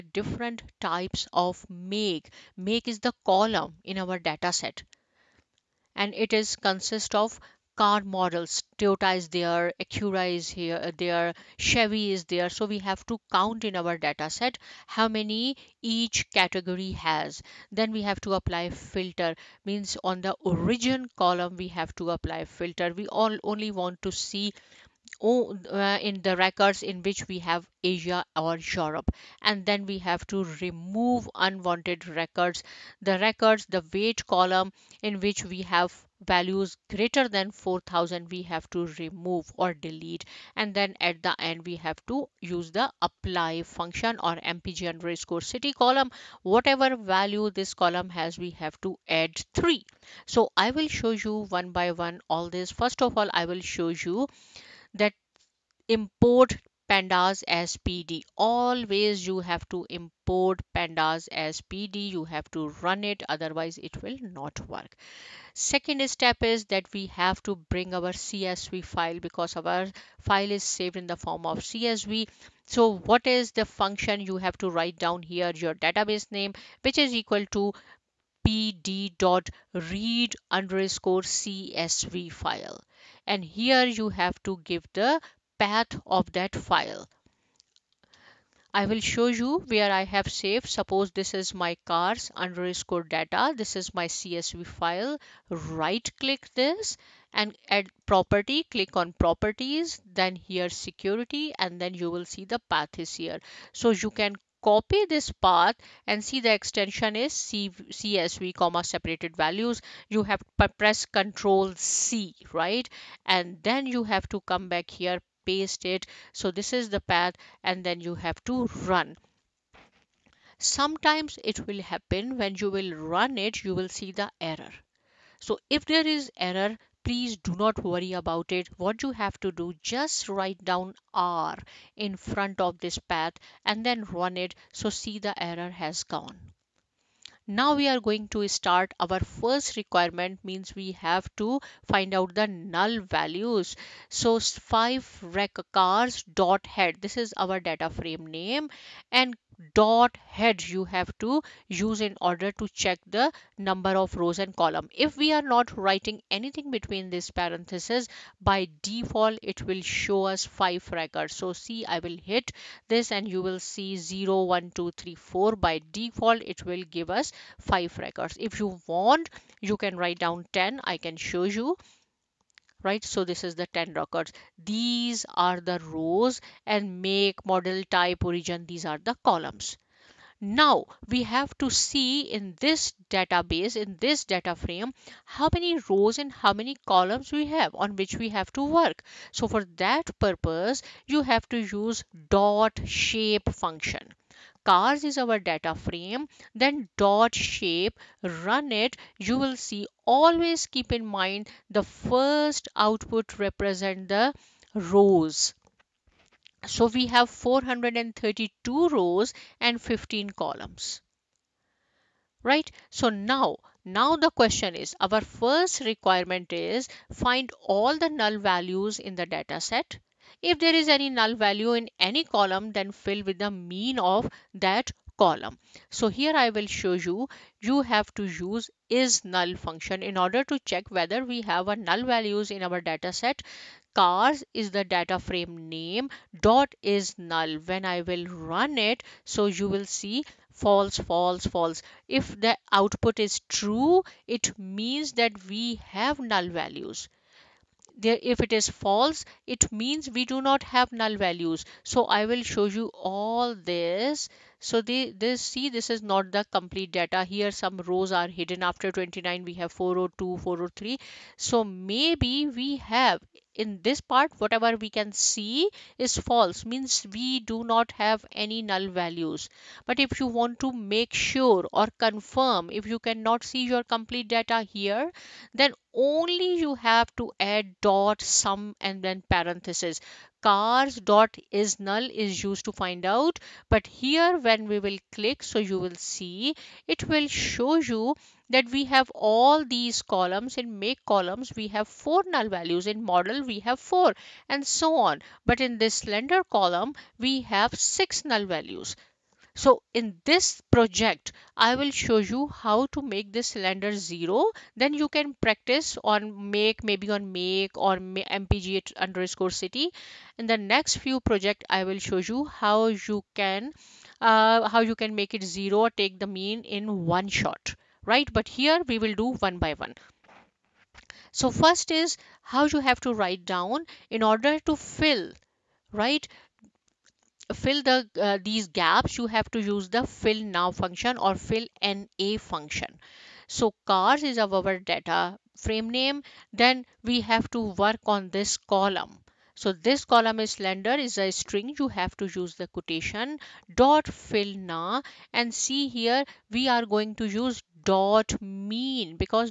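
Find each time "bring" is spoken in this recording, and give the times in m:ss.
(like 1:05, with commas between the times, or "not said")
1:07.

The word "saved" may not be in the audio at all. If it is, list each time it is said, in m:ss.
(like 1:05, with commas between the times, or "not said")
1:10, 1:30.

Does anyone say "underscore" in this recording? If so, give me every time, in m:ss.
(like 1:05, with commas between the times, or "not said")
0:44, 1:20, 1:32, 5:08.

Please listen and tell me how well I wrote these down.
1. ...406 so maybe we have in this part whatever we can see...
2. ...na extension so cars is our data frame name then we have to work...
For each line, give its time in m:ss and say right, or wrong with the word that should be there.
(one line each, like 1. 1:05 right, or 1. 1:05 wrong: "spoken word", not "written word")
1. 4:20 wrong: "403", not "406"
2. 5:31 wrong: "function", not "extension".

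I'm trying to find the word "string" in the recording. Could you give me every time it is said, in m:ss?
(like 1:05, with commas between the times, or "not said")
5:41.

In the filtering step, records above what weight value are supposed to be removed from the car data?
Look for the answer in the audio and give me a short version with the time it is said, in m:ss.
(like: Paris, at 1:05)
4000, at 0:37.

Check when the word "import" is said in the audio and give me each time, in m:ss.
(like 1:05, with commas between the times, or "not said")
0:55, 0:59.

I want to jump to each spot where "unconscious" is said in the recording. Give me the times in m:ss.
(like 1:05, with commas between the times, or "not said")
not said.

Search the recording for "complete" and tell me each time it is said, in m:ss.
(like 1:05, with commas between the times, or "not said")
4:16, 4:33.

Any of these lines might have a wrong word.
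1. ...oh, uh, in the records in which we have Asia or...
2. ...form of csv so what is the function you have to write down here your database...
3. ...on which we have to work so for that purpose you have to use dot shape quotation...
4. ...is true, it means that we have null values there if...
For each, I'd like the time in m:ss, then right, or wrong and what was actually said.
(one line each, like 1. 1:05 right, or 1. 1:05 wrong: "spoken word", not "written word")
1. 0:25 right
2. 1:11 right
3. 3:07 wrong: "function", not "quotation"
4. 4:03 right.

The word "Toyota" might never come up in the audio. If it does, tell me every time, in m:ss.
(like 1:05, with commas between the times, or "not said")
0:08.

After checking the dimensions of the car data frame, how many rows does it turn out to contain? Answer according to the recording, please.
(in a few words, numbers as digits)
432.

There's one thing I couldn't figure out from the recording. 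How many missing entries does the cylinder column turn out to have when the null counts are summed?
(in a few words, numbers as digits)
6.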